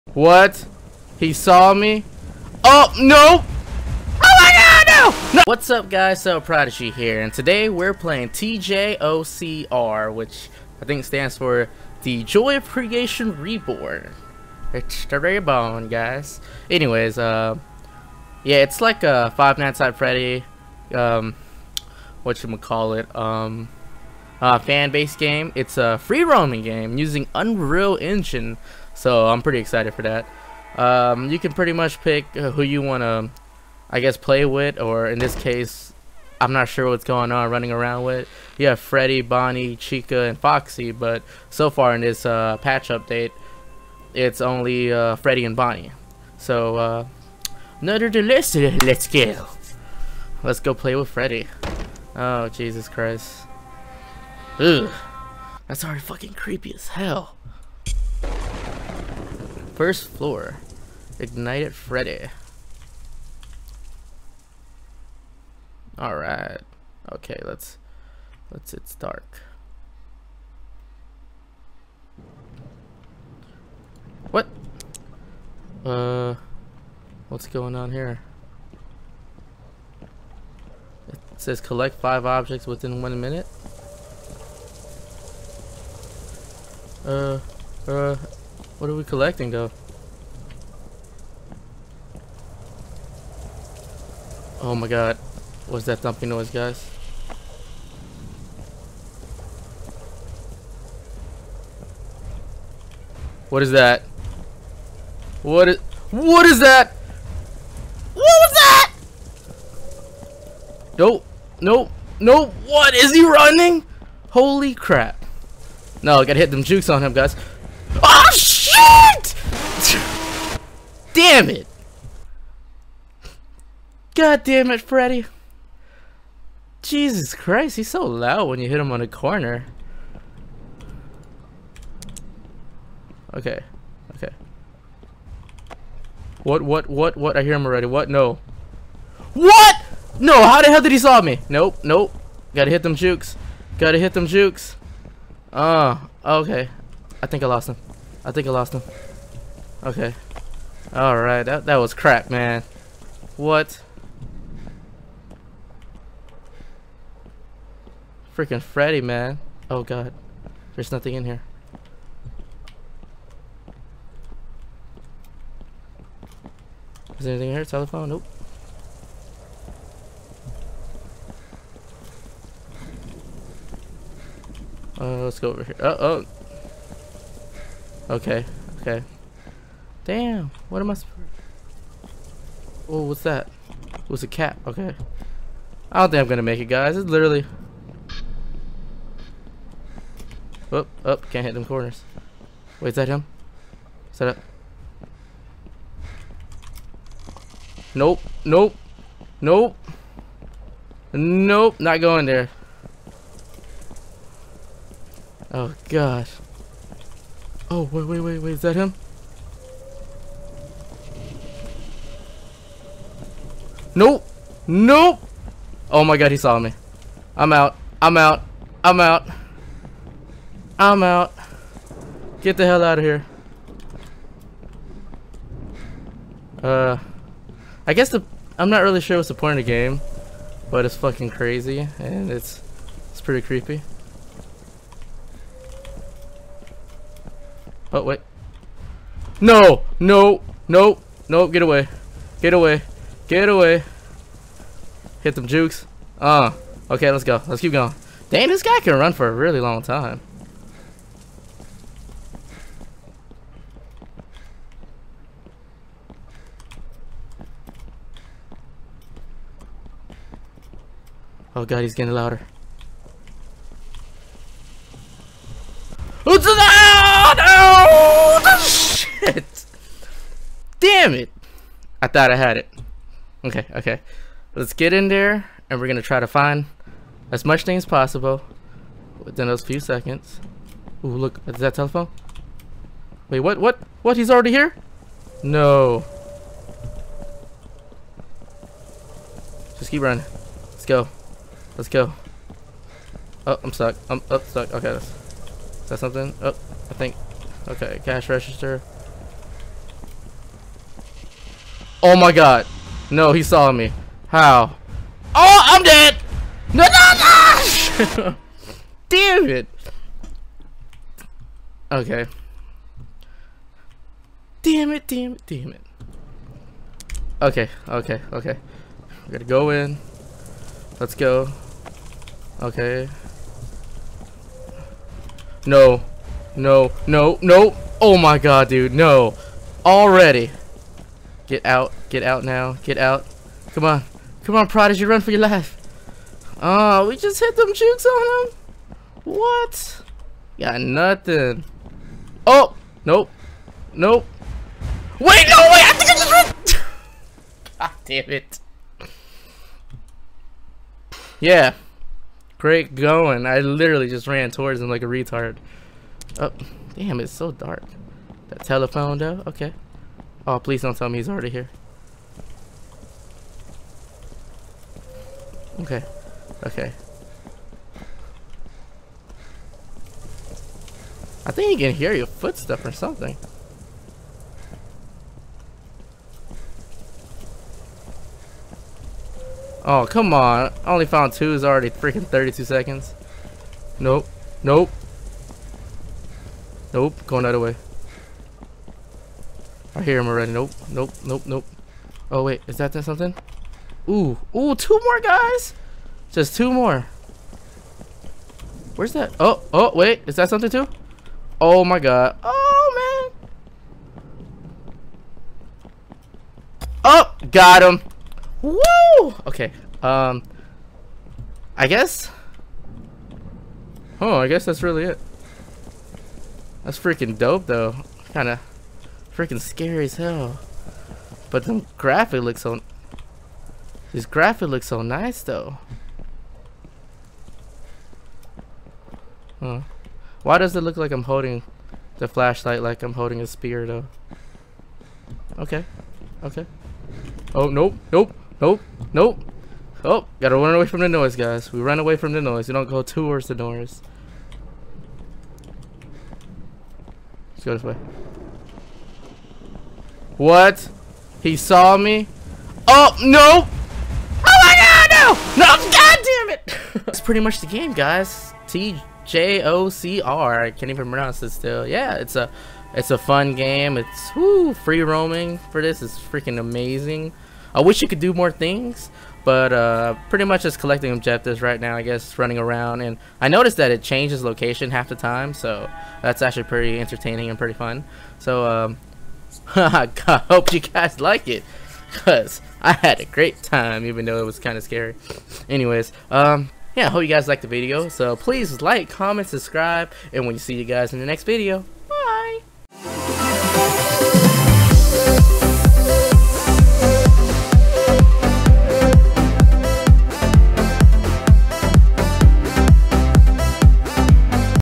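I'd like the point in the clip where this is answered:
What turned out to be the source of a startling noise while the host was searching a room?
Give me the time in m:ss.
3:04.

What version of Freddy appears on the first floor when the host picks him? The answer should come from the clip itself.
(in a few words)
Ignited Freddy.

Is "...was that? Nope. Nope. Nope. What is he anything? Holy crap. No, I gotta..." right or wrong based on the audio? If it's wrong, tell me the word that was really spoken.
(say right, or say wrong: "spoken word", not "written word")
wrong: "running", not "anything".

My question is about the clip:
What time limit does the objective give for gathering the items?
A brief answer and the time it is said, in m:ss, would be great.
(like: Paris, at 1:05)
1 minute, at 1:23.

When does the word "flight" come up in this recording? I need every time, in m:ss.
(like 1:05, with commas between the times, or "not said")
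not said.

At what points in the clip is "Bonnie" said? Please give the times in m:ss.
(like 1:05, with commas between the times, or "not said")
0:39, 0:45.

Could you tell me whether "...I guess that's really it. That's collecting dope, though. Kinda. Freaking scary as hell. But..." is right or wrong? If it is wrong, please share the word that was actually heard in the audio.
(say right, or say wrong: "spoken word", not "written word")
wrong: "freaking", not "collecting".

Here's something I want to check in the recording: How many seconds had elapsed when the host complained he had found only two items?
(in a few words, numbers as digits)
32.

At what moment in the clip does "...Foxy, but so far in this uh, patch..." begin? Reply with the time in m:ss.
0:40.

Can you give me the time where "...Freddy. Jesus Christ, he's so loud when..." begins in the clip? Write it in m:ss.
2:04.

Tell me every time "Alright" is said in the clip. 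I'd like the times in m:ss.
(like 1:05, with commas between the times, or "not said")
1:05, 2:30.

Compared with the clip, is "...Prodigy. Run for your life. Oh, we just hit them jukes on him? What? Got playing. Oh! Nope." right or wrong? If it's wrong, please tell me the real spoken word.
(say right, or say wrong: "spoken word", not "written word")
wrong: "nothing", not "playing".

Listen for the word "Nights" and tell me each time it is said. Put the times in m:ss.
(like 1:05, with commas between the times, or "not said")
0:19.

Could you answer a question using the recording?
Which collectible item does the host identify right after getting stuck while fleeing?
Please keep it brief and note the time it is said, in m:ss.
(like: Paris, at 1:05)
Cash register, at 4:58.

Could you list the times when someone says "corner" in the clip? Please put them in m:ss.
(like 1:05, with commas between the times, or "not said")
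2:09, 3:11.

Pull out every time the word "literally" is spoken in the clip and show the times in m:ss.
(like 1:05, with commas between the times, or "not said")
3:07, 5:53.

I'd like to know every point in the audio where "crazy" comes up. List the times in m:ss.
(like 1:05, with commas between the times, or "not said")
3:51.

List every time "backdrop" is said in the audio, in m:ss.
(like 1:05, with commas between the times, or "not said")
not said.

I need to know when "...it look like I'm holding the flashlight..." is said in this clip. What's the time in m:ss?
7:10.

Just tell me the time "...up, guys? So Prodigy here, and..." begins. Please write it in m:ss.
0:05.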